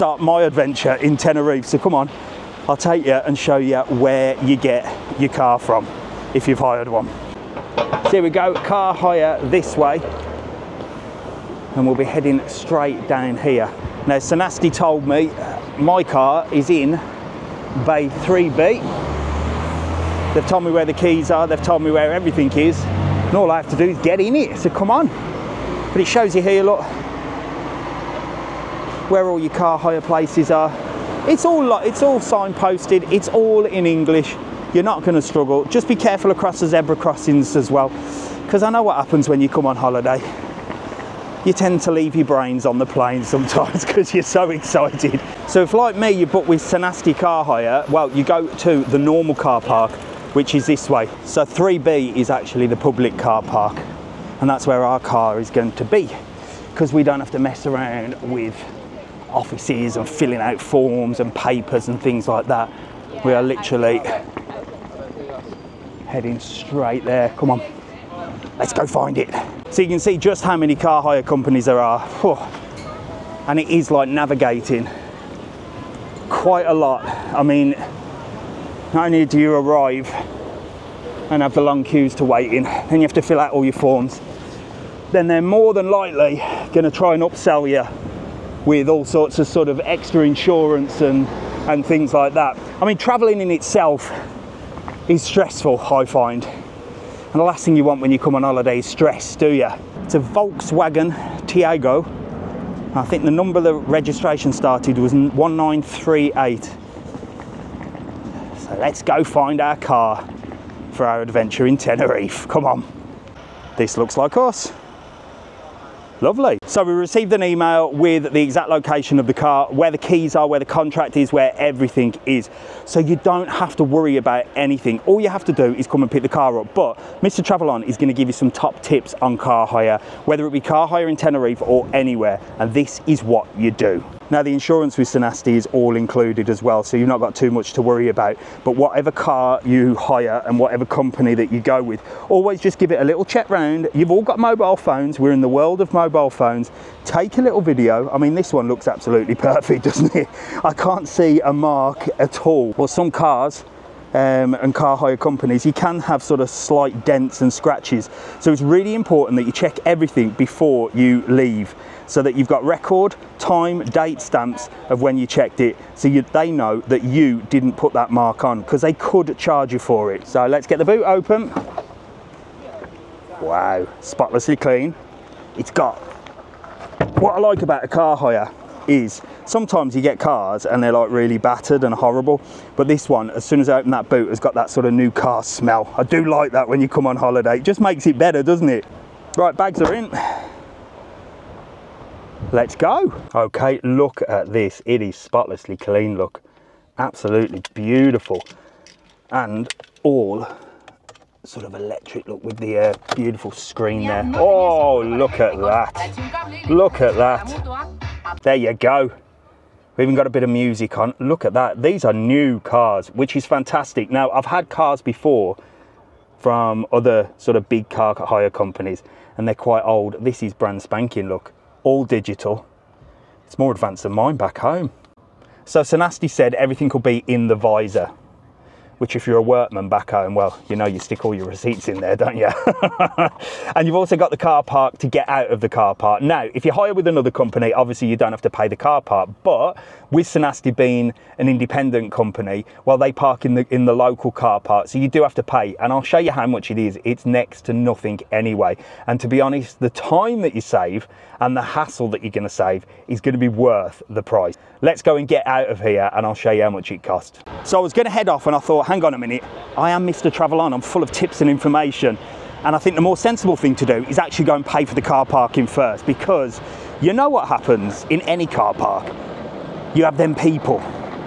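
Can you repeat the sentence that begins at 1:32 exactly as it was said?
I mean, traveling in itself is stressful, I find.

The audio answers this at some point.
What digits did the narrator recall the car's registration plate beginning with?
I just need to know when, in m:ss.
1:45.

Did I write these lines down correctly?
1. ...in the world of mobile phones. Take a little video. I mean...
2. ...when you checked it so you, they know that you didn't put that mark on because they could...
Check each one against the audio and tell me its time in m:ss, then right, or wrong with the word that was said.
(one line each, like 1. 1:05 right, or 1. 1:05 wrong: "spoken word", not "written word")
1. 2:25 right
2. 2:44 right.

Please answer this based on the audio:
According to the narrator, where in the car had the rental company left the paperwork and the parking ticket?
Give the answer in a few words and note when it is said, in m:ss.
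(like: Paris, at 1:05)
In the visor, at 3:47.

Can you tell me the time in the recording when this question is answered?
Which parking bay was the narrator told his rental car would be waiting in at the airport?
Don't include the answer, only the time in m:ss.
0:17.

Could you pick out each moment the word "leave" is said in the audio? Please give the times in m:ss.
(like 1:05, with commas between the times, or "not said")
0:41, 2:41.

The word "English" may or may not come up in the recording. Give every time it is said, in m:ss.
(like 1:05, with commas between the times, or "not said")
0:33.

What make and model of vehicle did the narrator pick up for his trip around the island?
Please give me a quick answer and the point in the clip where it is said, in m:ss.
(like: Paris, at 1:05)
Volkswagen Taigo, at 1:40.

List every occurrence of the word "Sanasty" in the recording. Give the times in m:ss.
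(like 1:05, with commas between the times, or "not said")
0:14, 0:46, 2:15, 3:45, 4:00.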